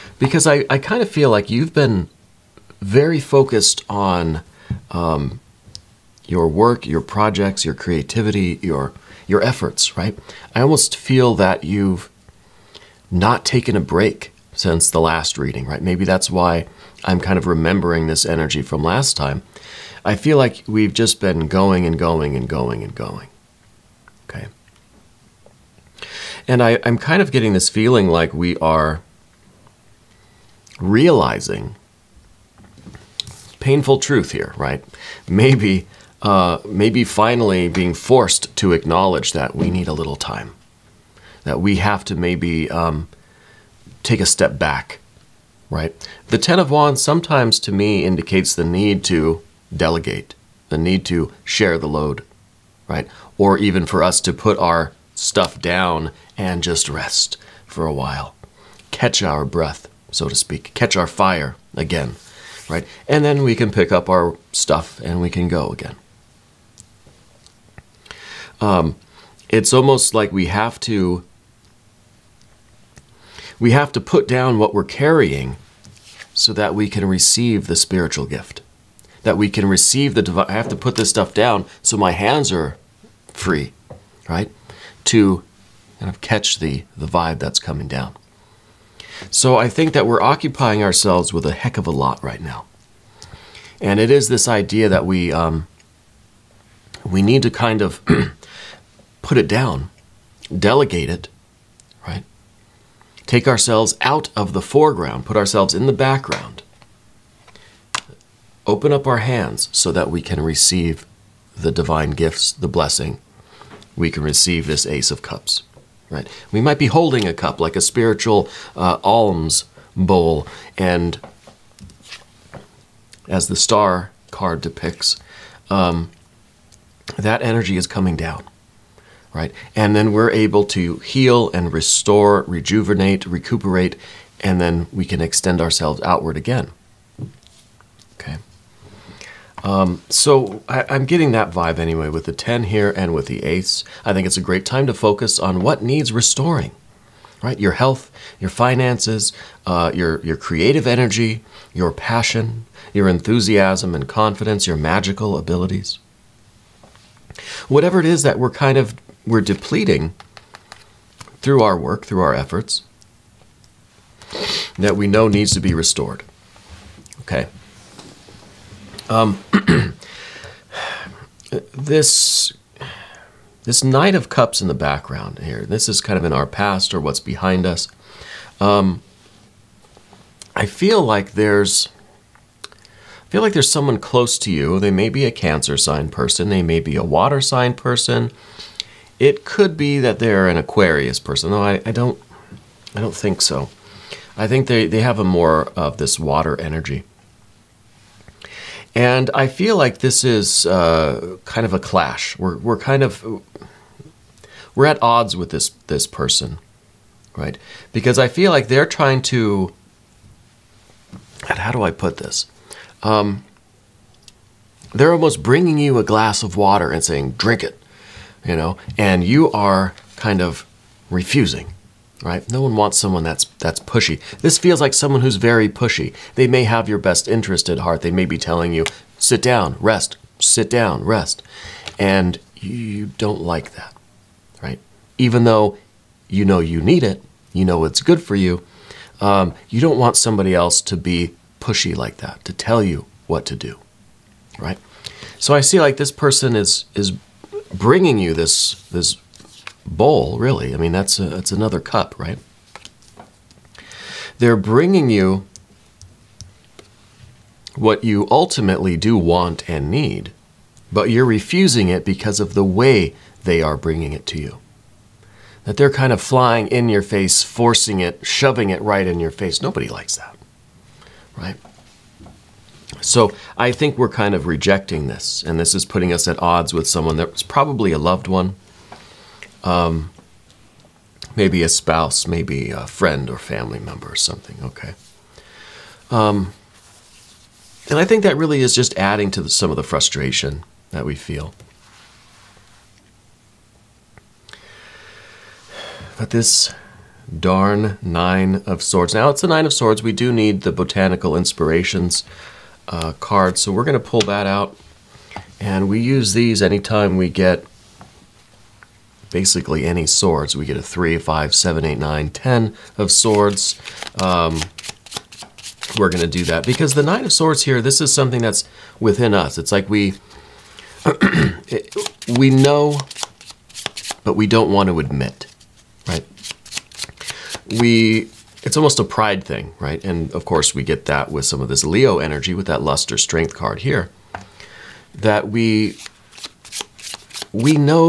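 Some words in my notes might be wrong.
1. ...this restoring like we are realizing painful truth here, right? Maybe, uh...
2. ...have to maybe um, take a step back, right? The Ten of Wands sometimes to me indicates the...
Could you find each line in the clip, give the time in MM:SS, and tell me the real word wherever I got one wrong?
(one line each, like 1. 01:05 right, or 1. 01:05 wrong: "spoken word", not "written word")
1. 00:27 wrong: "feeling", not "restoring"
2. 00:41 right.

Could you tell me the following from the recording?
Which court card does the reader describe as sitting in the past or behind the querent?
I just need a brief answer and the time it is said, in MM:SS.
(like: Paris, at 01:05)
Knight of Cups, at 02:53.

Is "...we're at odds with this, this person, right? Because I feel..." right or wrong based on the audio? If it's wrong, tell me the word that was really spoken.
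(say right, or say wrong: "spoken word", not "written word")
right.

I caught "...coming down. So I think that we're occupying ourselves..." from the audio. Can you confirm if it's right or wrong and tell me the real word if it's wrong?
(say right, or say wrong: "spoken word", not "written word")
right.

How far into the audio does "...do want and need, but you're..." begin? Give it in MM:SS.
04:18.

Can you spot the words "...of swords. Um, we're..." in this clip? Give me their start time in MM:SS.
05:12.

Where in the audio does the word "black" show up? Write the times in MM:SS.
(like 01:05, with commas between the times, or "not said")
not said.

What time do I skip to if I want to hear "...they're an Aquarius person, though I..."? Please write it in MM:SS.
03:10.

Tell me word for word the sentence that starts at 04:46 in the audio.
Um, and I think that really is just adding to the, some of the frustration that we feel.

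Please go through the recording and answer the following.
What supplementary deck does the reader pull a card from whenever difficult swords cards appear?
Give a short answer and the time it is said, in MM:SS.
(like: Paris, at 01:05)
Botanical Inspirations, at 05:00.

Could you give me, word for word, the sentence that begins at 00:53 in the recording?
Or even for us to put our stuff down and just rest for a while.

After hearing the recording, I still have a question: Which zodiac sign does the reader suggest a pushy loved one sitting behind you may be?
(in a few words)
Cancer.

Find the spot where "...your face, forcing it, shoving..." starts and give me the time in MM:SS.
04:26.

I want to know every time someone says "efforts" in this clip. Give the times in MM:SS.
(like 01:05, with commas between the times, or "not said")
00:09, 02:42.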